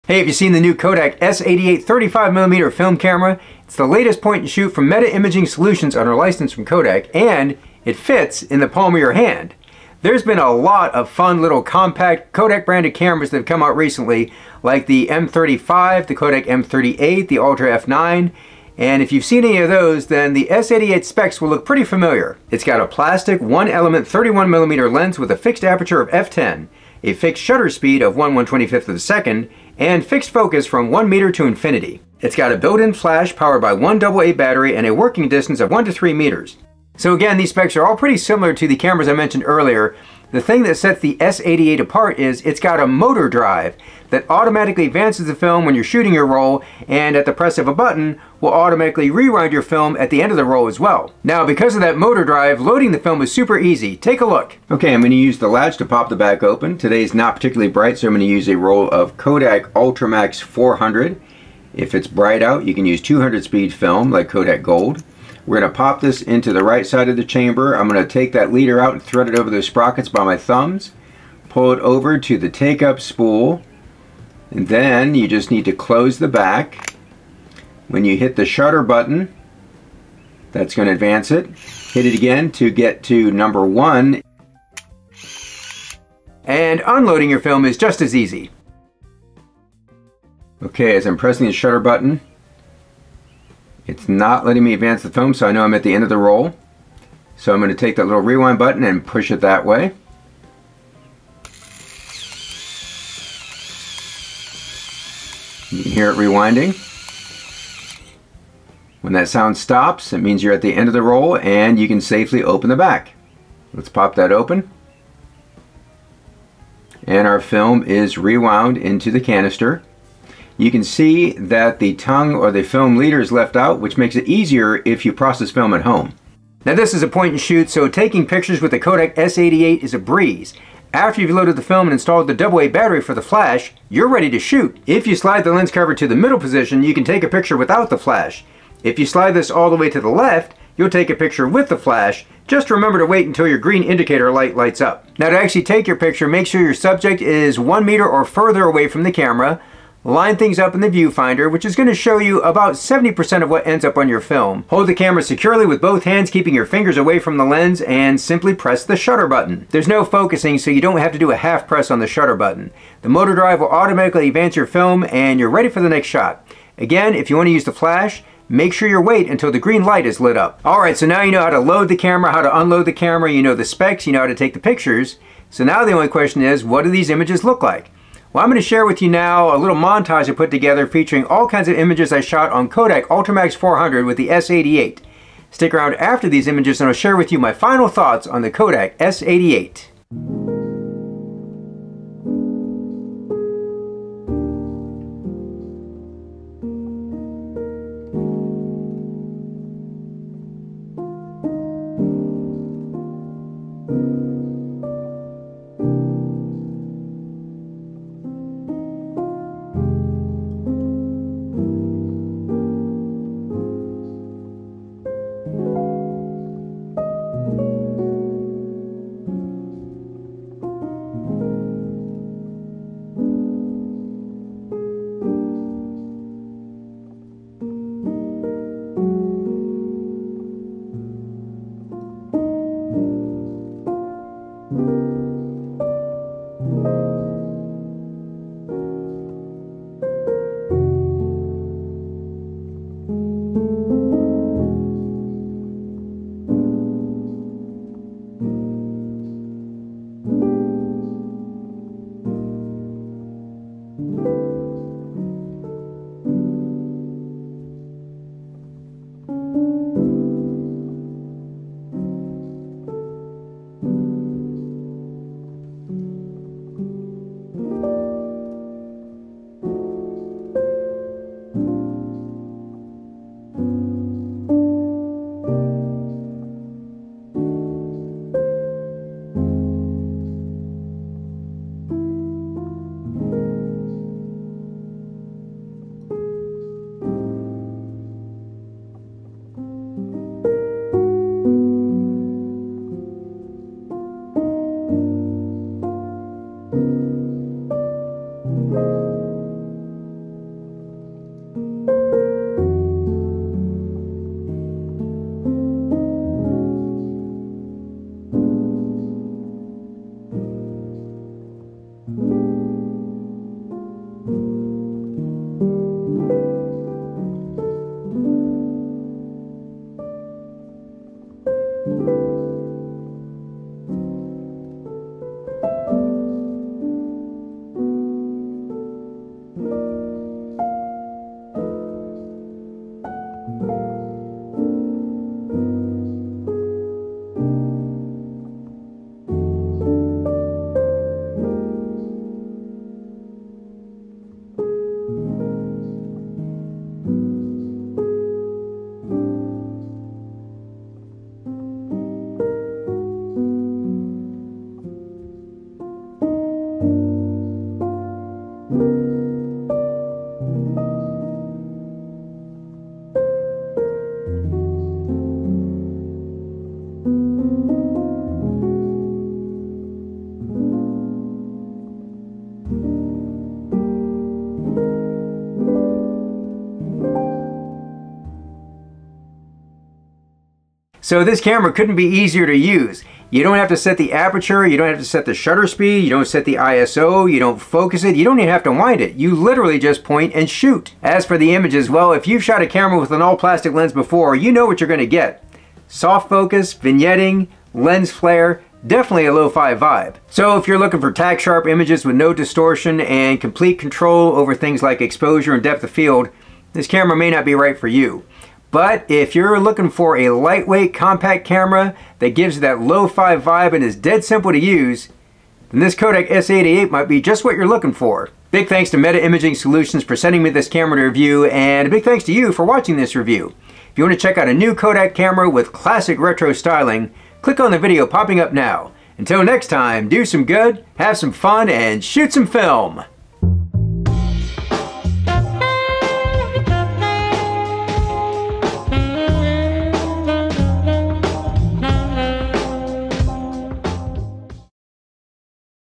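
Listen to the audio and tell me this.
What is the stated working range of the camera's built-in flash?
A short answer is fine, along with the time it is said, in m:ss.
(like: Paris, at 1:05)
1 to 3 meters, at 0:35.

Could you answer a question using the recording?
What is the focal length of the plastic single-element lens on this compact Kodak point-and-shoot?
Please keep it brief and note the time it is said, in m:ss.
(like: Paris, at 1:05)
31mm, at 0:24.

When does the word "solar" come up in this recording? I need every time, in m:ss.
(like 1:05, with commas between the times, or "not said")
not said.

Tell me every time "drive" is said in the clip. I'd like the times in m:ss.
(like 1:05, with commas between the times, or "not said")
0:43, 0:52, 2:43.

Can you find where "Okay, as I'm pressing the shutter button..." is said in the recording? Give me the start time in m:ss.
1:30.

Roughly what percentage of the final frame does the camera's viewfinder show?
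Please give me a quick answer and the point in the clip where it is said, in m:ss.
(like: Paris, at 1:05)
70%, at 2:32.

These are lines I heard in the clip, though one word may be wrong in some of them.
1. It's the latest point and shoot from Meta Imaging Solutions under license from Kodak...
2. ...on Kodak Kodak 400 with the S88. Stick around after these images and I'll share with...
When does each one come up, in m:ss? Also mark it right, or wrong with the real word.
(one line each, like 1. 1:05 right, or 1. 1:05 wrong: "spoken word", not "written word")
1. 0:03 right
2. 3:02 wrong: "Ultramax", not "Kodak".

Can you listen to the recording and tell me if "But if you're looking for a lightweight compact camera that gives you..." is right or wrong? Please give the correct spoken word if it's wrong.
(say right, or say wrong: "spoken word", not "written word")
right.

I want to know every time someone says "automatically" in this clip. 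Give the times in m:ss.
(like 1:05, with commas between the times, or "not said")
0:44, 0:48, 2:43.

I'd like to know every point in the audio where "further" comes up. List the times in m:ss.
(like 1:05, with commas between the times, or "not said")
2:28.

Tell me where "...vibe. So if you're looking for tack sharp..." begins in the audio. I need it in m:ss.
6:39.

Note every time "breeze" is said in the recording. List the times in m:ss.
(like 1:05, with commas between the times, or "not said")
2:09.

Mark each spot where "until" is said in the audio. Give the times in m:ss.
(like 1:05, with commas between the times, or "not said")
2:23, 2:49, 7:09.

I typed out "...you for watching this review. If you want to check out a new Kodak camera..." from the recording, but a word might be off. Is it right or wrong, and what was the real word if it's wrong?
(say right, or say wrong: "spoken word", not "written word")
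right.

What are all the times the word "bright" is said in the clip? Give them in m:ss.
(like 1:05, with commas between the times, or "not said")
0:57, 1:02.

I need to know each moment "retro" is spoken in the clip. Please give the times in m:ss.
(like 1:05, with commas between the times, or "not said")
7:06.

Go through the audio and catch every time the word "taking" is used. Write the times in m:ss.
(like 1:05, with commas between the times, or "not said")
2:07.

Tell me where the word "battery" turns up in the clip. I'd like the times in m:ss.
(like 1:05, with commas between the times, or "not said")
0:34, 2:12.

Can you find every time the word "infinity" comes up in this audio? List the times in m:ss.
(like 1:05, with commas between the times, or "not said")
0:31.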